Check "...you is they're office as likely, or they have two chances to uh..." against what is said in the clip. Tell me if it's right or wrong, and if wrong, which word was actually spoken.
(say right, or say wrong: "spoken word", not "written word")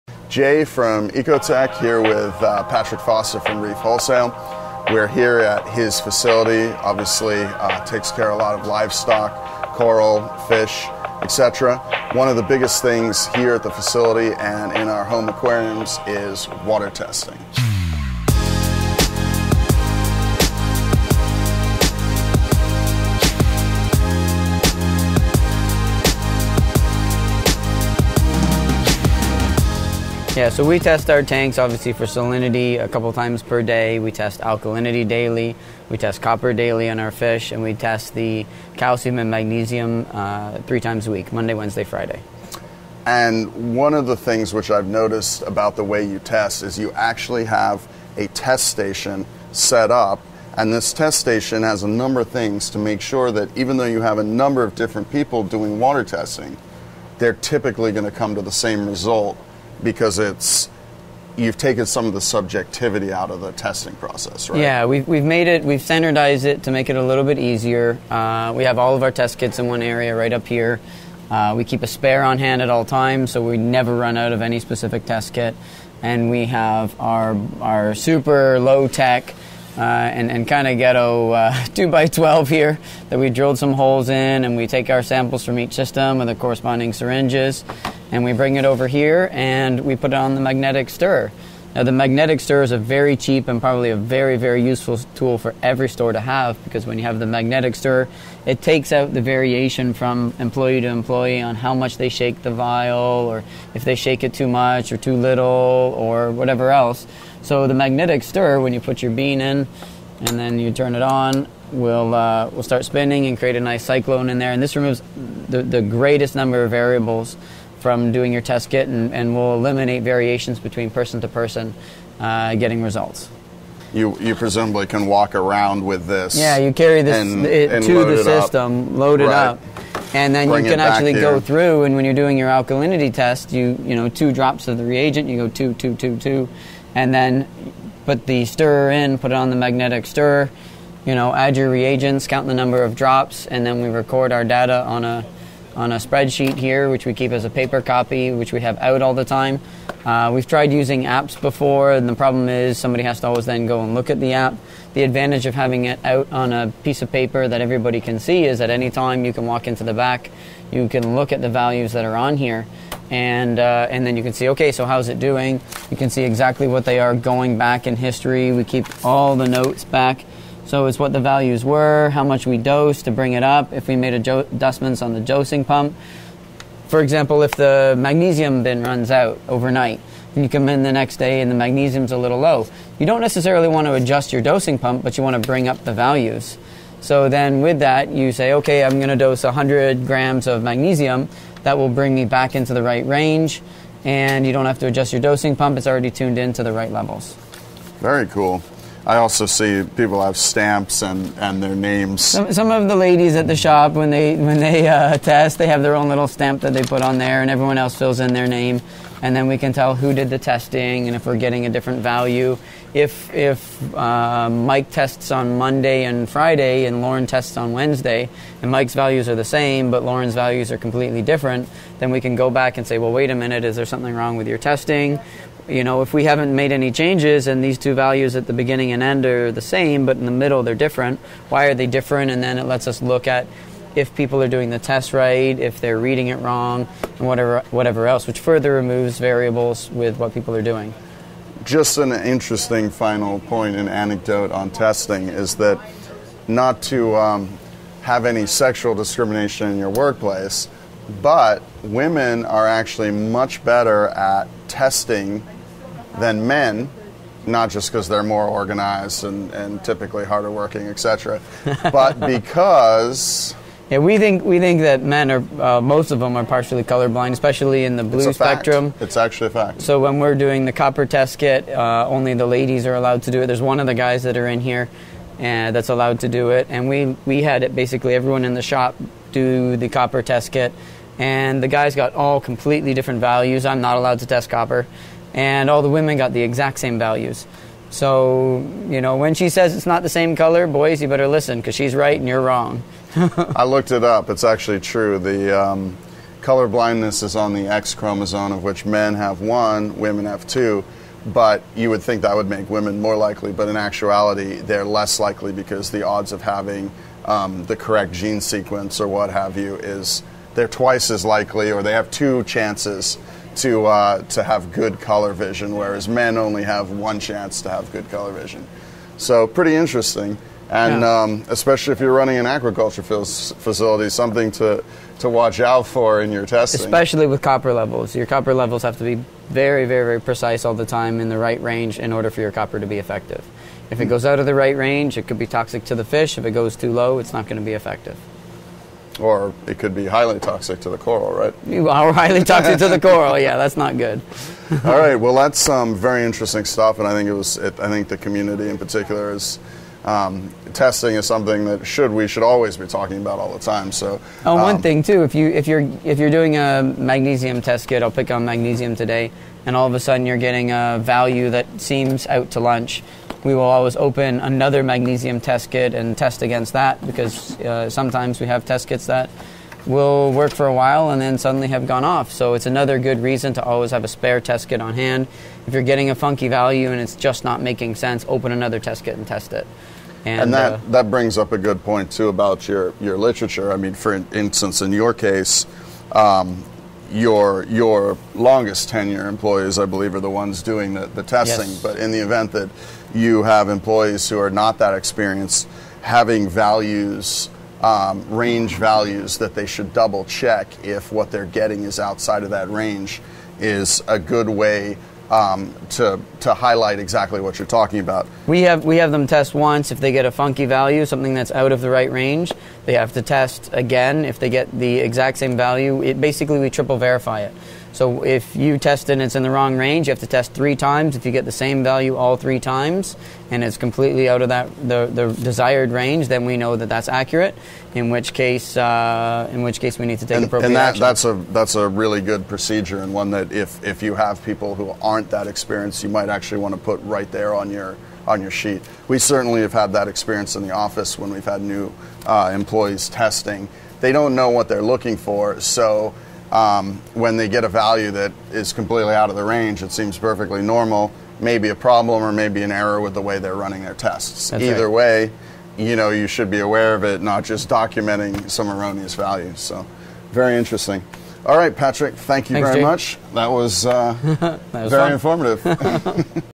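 wrong: "twice", not "office".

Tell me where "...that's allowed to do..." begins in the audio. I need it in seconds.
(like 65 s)
275 s.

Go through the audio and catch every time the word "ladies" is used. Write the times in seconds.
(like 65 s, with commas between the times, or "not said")
202 s, 272 s.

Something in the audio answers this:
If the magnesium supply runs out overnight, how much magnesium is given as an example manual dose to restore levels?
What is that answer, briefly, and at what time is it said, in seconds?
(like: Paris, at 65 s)
100 grams, at 189 s.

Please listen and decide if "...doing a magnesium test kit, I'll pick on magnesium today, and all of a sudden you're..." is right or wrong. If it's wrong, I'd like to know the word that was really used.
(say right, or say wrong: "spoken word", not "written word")
right.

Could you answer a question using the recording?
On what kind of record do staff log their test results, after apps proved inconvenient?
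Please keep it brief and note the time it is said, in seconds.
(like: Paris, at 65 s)
spreadsheet, at 145 s.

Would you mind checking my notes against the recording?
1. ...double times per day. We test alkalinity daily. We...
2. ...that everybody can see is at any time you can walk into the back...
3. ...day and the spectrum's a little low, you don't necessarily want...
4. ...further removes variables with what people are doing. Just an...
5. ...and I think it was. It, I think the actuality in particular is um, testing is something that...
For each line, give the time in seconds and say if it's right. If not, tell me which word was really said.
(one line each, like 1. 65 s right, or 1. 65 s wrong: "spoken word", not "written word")
1. 32 s wrong: "couple", not "double"
2. 157 s right
3. 181 s wrong: "magnesium", not "spectrum"
4. 238 s right
5. 346 s wrong: "community", not "actuality".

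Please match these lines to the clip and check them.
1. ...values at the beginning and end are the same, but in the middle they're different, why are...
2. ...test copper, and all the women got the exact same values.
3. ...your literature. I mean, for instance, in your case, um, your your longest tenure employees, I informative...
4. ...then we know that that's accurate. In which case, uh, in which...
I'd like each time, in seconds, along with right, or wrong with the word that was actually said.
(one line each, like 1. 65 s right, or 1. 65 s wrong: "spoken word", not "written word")
1. 227 s right
2. 284 s right
3. 382 s wrong: "believe", not "informative"
4. 426 s right.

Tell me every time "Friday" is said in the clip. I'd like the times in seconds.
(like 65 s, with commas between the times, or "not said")
41 s, 216 s.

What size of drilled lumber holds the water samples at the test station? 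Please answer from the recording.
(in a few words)
2x12.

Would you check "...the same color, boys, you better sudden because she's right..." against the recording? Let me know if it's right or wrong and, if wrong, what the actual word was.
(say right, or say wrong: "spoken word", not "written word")
wrong: "listen", not "sudden".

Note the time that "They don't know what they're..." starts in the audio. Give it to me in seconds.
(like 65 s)
443 s.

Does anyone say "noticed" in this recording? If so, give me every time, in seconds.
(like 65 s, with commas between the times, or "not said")
44 s.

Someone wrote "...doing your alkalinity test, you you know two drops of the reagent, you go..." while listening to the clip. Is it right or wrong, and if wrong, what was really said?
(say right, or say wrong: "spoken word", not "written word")
right.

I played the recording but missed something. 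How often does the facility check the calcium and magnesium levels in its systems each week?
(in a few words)
3 times a week.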